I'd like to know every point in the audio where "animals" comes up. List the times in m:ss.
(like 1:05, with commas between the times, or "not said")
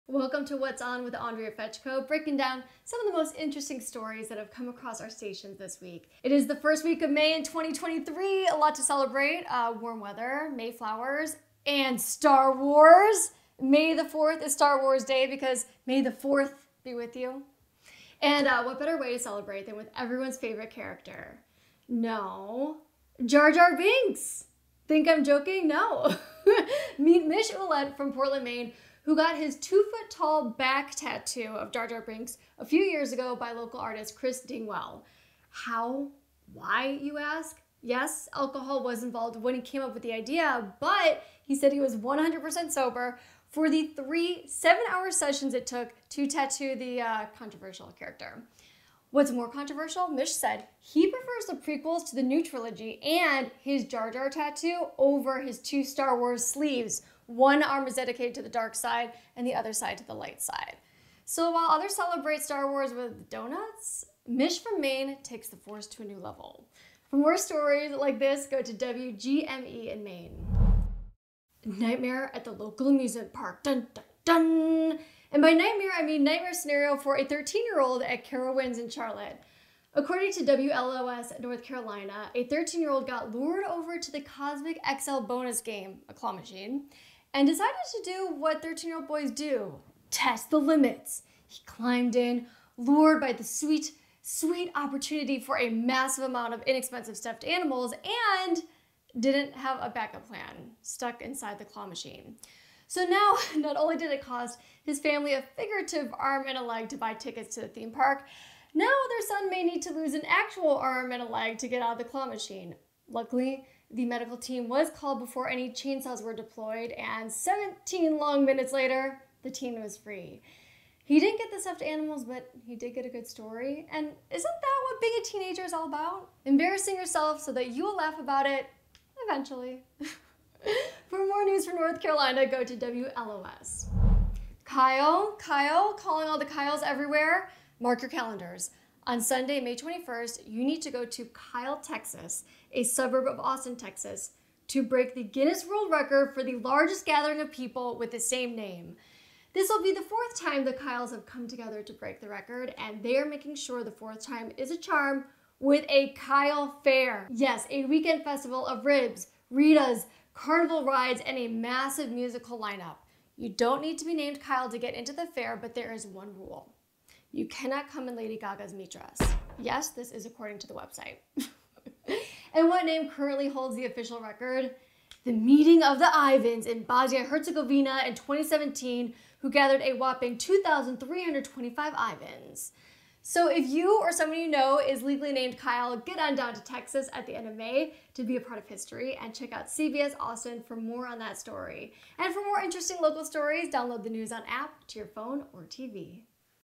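1:37, 2:01.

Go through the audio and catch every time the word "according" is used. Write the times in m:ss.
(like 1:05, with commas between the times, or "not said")
1:19, 2:50.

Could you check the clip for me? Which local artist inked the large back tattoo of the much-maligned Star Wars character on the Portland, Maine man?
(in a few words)
Chris Dingwell.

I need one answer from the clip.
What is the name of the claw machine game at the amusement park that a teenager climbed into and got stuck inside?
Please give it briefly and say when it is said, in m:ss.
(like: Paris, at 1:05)
Cosmic XL, at 1:24.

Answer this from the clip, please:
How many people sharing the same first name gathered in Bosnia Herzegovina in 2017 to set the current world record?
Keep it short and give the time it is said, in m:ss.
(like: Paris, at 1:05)
2,325, at 3:00.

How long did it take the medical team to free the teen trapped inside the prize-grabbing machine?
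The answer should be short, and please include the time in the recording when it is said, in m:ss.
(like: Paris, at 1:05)
17 minutes, at 1:57.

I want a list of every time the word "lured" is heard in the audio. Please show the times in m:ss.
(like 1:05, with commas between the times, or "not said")
1:23, 1:32.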